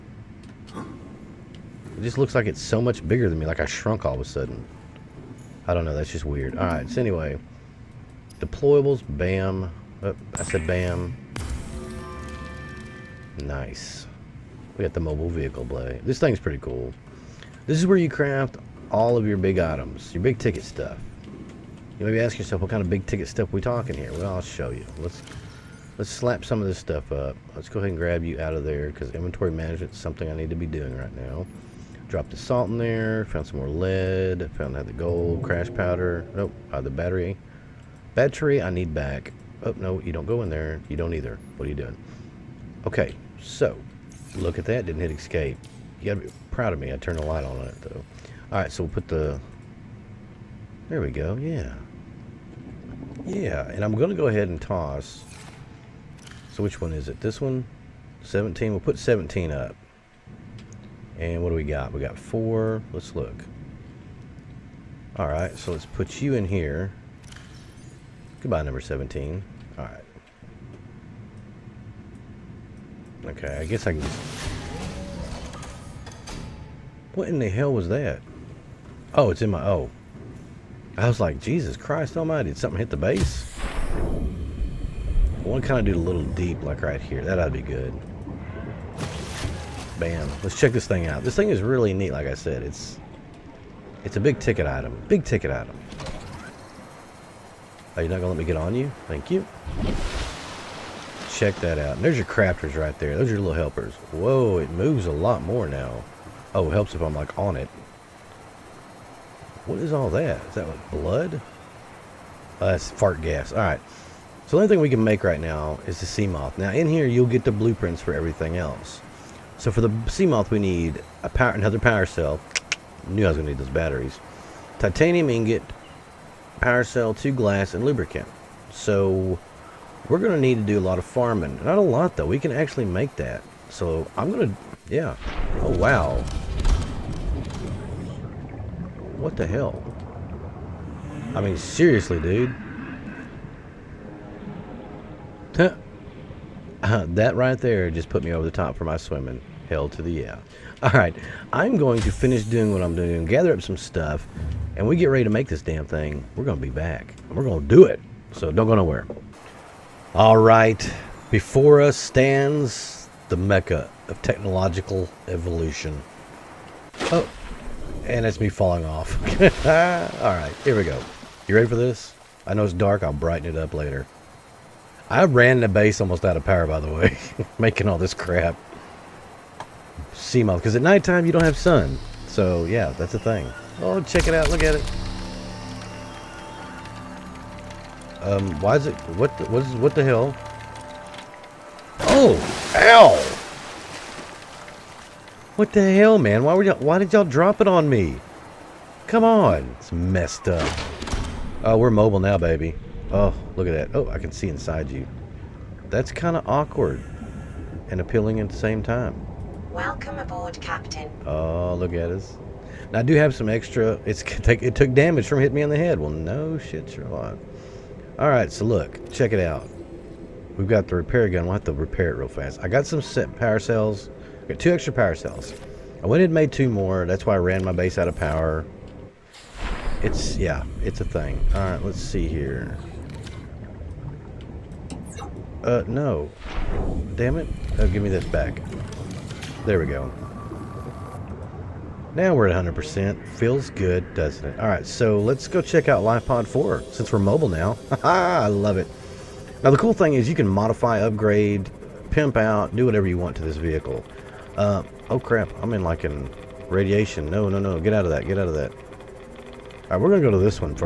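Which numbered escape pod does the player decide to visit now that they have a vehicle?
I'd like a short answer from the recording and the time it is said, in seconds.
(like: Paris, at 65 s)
LifePod 4, at 246 s.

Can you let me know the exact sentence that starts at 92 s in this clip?
It's it's a big ticket item.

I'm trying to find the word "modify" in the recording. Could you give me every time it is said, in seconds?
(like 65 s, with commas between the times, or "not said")
250 s.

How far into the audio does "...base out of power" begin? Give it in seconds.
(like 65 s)
227 s.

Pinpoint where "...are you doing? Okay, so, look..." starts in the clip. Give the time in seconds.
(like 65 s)
41 s.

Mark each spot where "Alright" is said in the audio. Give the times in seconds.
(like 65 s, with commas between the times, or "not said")
6 s, 48 s, 113 s.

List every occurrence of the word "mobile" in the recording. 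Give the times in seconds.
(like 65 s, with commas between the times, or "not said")
14 s, 201 s, 247 s.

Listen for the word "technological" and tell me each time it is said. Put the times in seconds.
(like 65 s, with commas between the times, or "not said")
164 s.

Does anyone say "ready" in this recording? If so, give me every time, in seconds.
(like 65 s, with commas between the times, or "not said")
155 s, 171 s.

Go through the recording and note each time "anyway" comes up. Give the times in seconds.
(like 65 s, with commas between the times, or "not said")
6 s.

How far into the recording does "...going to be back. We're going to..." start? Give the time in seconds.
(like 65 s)
156 s.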